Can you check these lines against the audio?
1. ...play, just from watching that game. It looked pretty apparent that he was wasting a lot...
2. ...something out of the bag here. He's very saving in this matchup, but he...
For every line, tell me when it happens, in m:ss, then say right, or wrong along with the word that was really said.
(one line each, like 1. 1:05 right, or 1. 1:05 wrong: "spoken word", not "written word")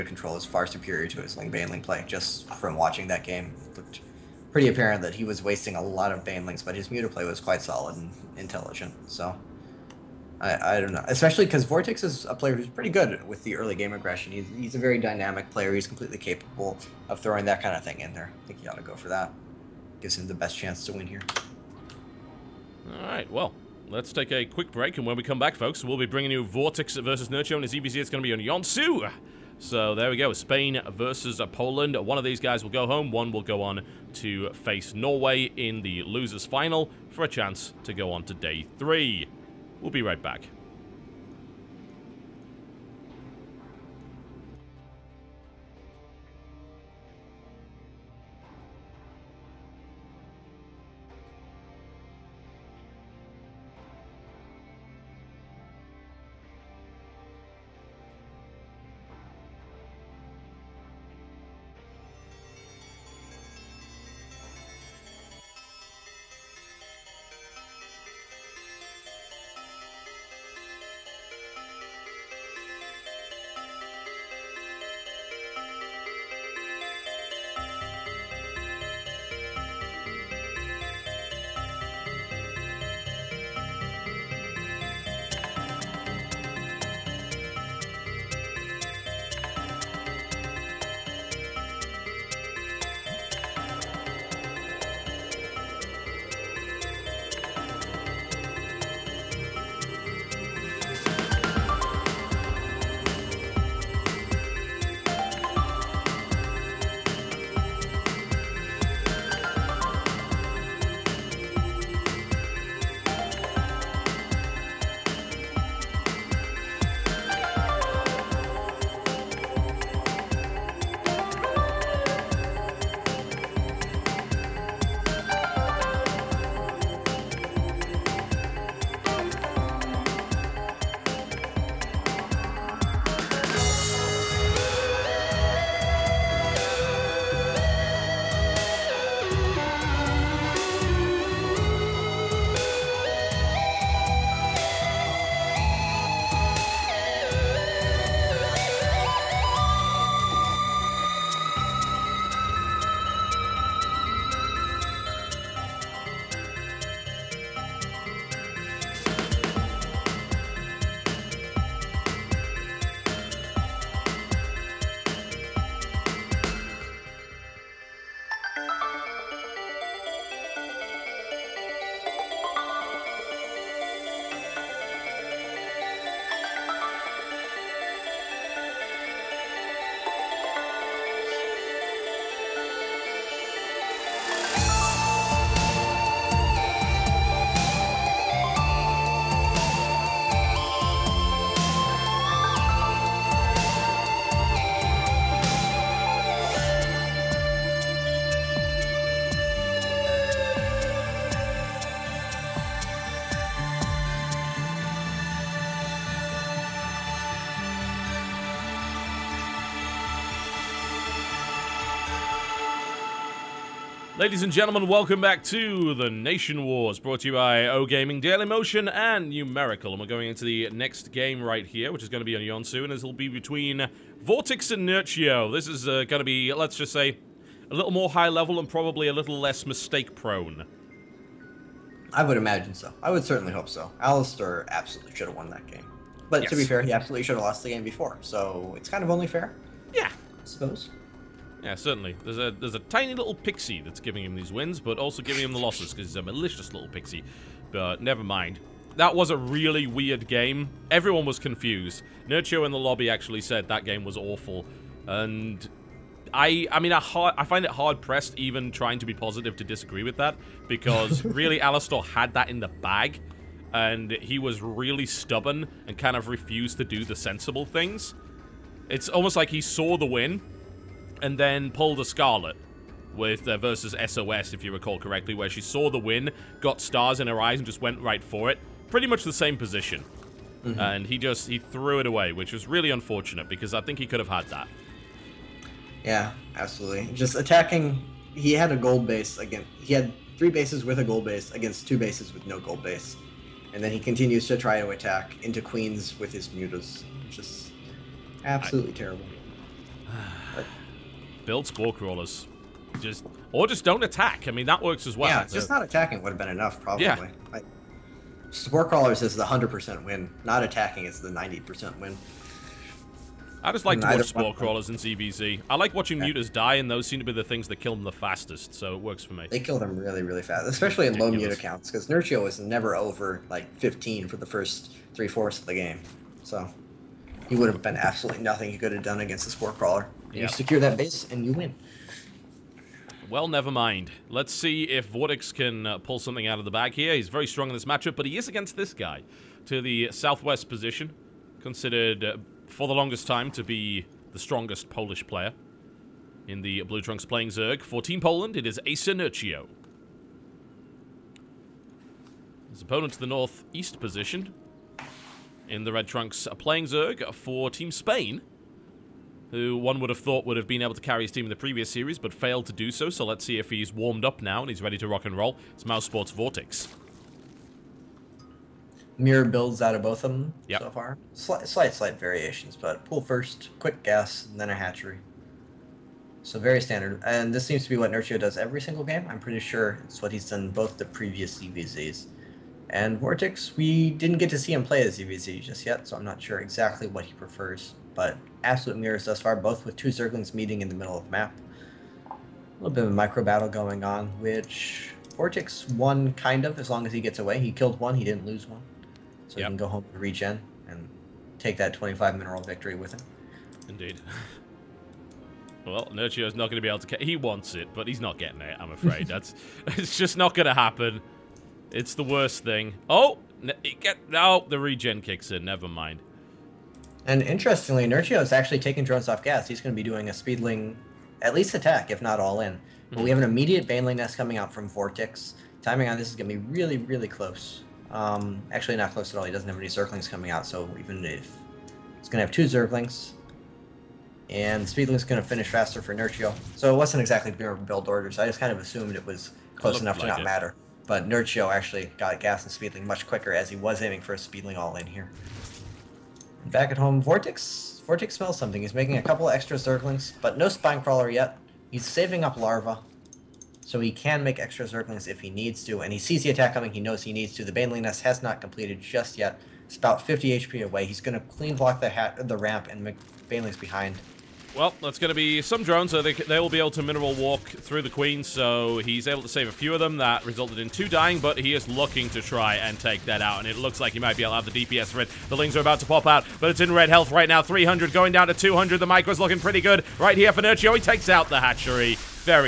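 1. 0:01 right
2. 5:36 wrong: "strong", not "saving".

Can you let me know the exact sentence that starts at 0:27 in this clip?
It's going to be on Yeonsu.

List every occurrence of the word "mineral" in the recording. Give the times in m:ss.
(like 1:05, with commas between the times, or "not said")
6:42, 7:47.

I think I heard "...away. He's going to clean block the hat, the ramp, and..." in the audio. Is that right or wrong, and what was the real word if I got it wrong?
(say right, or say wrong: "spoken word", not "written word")
right.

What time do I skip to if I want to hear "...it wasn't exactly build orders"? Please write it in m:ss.
7:16.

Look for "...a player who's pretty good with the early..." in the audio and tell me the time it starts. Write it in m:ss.
0:12.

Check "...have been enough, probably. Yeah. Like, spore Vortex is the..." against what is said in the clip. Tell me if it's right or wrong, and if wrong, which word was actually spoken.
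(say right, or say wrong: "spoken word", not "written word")
wrong: "Crawlers", not "Vortex".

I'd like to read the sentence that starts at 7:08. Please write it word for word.
Um, actually, not close at all.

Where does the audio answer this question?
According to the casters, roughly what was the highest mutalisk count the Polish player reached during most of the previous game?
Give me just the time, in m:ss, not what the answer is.
5:23.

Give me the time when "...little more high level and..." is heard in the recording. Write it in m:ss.
3:47.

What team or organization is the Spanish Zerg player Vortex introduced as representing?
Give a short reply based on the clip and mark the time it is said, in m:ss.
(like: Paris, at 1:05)
Mouse Sports, at 6:05.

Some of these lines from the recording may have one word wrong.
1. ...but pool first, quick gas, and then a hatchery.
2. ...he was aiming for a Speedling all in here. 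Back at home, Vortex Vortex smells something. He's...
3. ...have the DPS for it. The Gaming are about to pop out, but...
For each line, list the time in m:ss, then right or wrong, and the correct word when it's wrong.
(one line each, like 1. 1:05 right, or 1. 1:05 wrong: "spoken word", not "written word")
1. 6:12 right
2. 7:23 right
3. 7:54 wrong: "Lings", not "Gaming".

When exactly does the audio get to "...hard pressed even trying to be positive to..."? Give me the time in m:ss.
4:17.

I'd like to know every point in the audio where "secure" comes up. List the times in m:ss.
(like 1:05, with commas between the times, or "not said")
5:30.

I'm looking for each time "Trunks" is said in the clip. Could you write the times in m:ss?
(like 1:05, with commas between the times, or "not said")
5:47, 5:56.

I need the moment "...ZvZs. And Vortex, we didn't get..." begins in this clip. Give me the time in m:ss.
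6:21.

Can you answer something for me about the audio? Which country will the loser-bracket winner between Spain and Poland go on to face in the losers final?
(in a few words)
Norway.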